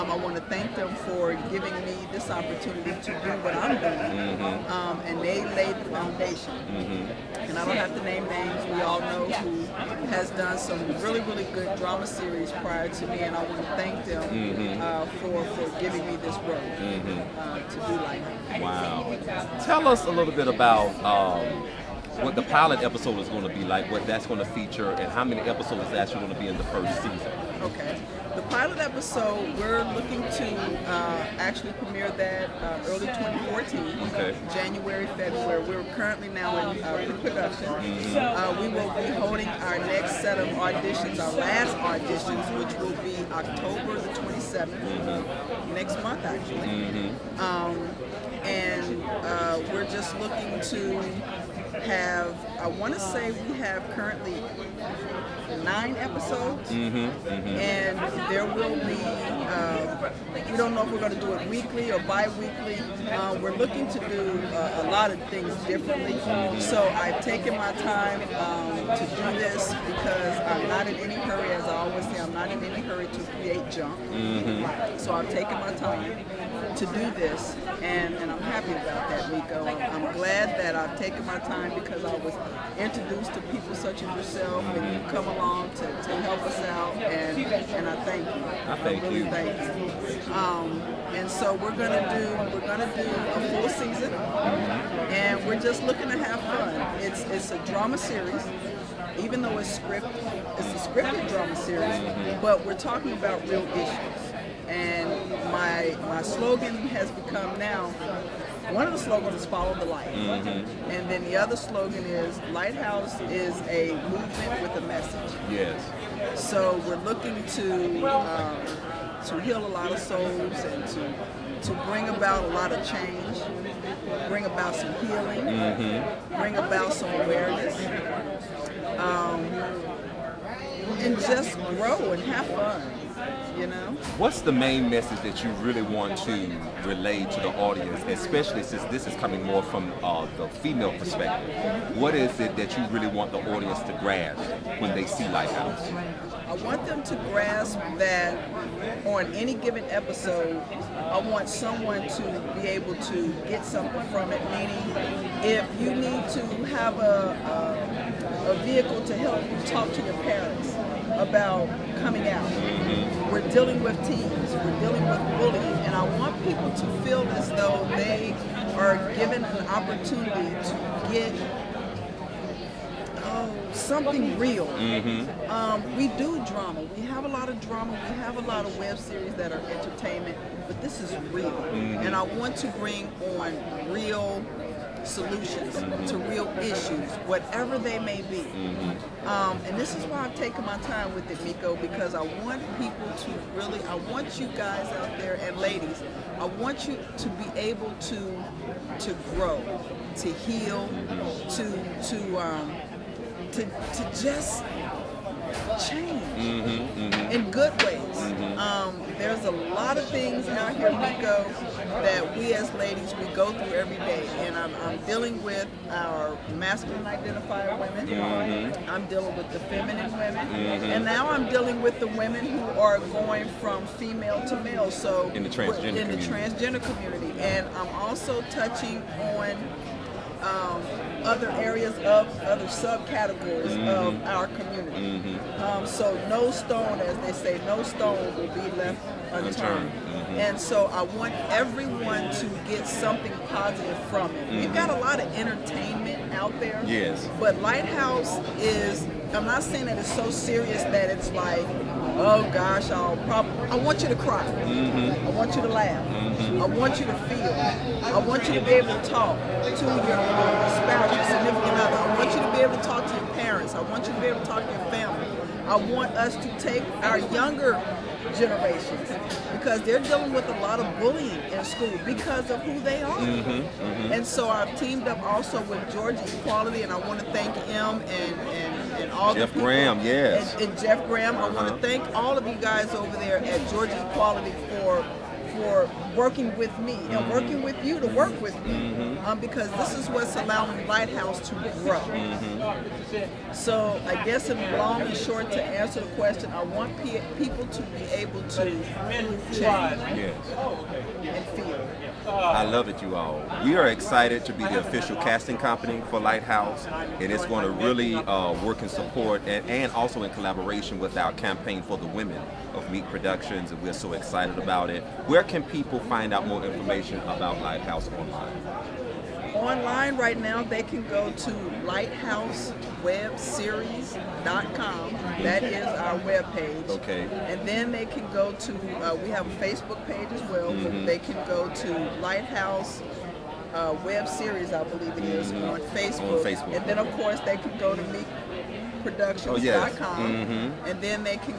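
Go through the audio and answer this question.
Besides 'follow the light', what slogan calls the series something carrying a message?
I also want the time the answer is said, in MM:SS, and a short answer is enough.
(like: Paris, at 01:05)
a movement with a message, at 01:53.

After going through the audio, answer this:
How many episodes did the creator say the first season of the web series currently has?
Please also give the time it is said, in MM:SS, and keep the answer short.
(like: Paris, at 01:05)
9, at 00:55.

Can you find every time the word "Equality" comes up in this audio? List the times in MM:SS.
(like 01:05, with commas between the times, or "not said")
04:36, 04:44.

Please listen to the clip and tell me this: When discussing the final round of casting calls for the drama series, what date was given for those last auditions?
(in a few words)
October 27.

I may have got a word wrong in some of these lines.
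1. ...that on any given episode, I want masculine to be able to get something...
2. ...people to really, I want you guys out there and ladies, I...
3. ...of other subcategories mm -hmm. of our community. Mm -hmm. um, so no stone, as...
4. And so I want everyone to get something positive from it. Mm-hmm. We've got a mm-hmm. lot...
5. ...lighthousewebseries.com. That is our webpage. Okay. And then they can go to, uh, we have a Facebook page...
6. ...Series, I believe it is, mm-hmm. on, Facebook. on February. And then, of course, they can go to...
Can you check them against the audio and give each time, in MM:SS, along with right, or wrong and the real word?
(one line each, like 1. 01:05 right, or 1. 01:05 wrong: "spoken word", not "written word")
1. 02:27 wrong: "someone", not "masculine"
2. 03:12 right
3. 03:52 right
4. 04:00 right
5. 05:21 right
6. 05:34 wrong: "Facebook", not "February".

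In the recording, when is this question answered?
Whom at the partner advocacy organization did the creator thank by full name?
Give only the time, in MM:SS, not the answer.
04:40.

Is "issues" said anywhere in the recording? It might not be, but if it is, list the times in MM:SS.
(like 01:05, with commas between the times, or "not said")
01:43, 03:06.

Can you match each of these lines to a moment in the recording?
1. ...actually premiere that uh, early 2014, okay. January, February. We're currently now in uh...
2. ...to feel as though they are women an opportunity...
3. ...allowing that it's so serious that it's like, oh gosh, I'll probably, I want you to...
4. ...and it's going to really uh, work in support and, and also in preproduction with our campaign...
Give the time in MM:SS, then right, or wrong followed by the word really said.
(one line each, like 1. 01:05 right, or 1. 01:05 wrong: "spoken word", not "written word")
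1. 00:31 right
2. 02:46 wrong: "given", not "women"
3. 04:09 wrong: "saying", not "allowing"
4. 05:06 wrong: "collaboration", not "preproduction".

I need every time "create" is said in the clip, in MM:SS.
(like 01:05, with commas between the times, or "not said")
01:13.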